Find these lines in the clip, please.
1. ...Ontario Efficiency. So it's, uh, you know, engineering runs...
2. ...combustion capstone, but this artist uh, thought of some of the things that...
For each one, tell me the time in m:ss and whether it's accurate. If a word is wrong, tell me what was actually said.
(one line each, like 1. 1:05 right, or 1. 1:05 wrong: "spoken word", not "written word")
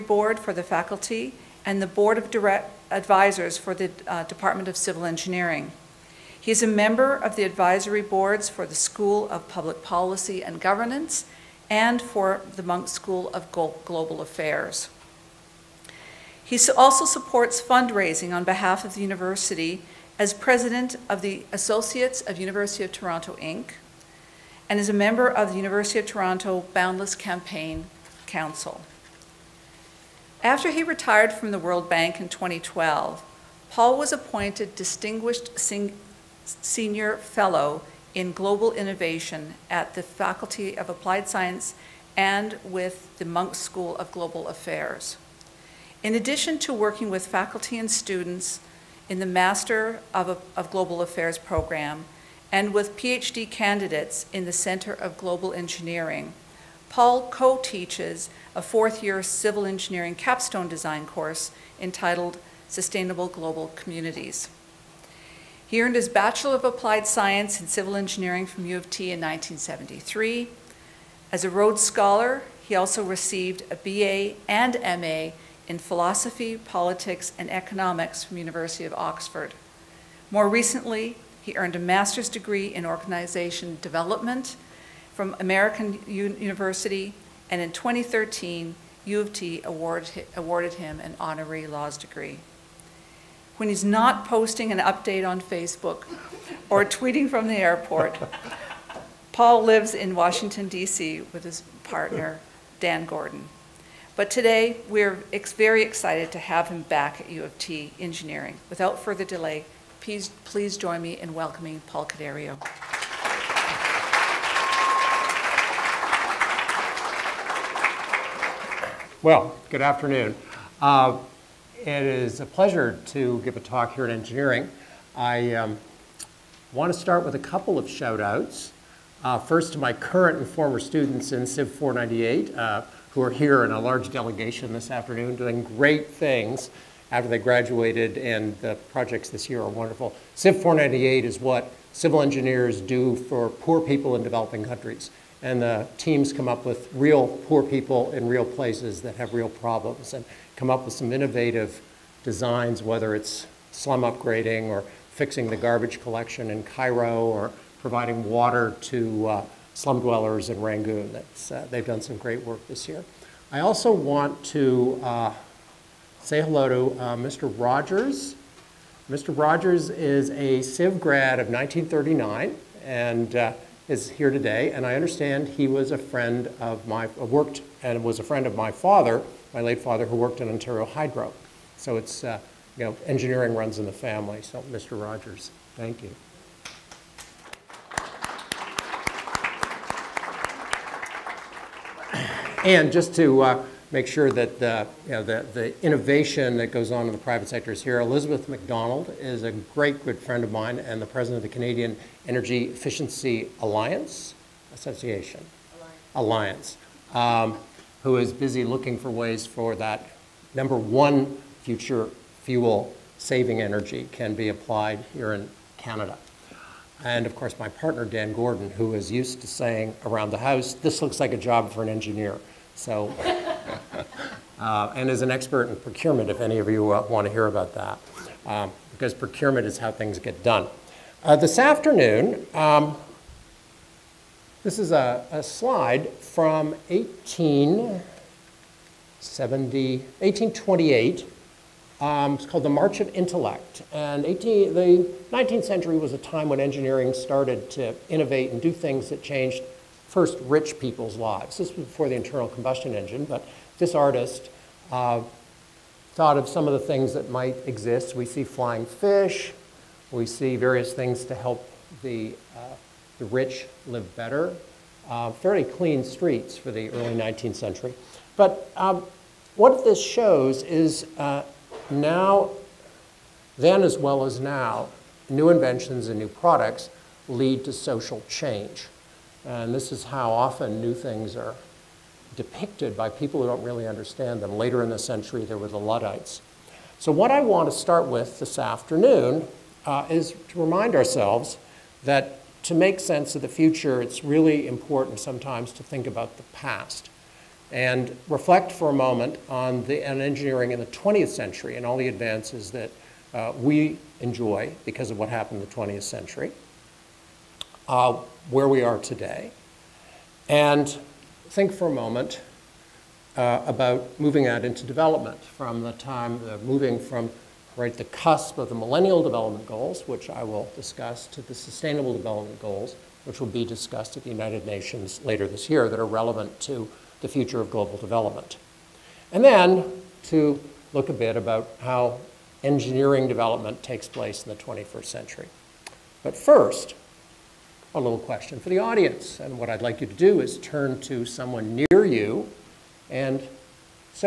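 1. 3:00 wrong: "Hydro", not "Efficiency"
2. 4:12 wrong: "engine", not "capstone".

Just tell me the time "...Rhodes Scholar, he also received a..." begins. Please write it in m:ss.
1:11.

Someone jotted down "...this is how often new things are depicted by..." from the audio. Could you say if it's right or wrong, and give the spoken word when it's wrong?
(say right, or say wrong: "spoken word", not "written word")
right.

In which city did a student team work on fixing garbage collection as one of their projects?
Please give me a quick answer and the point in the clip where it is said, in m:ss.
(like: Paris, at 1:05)
Cairo, at 2:36.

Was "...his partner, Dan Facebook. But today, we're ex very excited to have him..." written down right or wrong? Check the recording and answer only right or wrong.
wrong.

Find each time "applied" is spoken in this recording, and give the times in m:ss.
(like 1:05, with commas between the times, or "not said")
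0:40, 1:06, 3:34.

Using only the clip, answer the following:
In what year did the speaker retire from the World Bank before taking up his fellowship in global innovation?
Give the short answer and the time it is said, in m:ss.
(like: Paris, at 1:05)
2012, at 0:32.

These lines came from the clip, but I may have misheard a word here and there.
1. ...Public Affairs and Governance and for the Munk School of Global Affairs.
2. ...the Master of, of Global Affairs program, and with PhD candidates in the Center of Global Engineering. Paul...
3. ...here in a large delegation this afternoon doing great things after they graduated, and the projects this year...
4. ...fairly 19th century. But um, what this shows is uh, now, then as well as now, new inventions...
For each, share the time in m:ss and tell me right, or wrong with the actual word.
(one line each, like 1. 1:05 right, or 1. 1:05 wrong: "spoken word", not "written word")
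1. 0:09 wrong: "Policy", not "Affairs"
2. 0:49 right
3. 2:13 right
4. 4:26 wrong: "early", not "fairly".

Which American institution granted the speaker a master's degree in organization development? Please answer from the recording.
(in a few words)
American University.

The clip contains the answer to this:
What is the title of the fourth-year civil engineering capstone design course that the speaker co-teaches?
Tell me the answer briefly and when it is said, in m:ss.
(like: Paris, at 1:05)
Sustainable Global Communities, at 1:02.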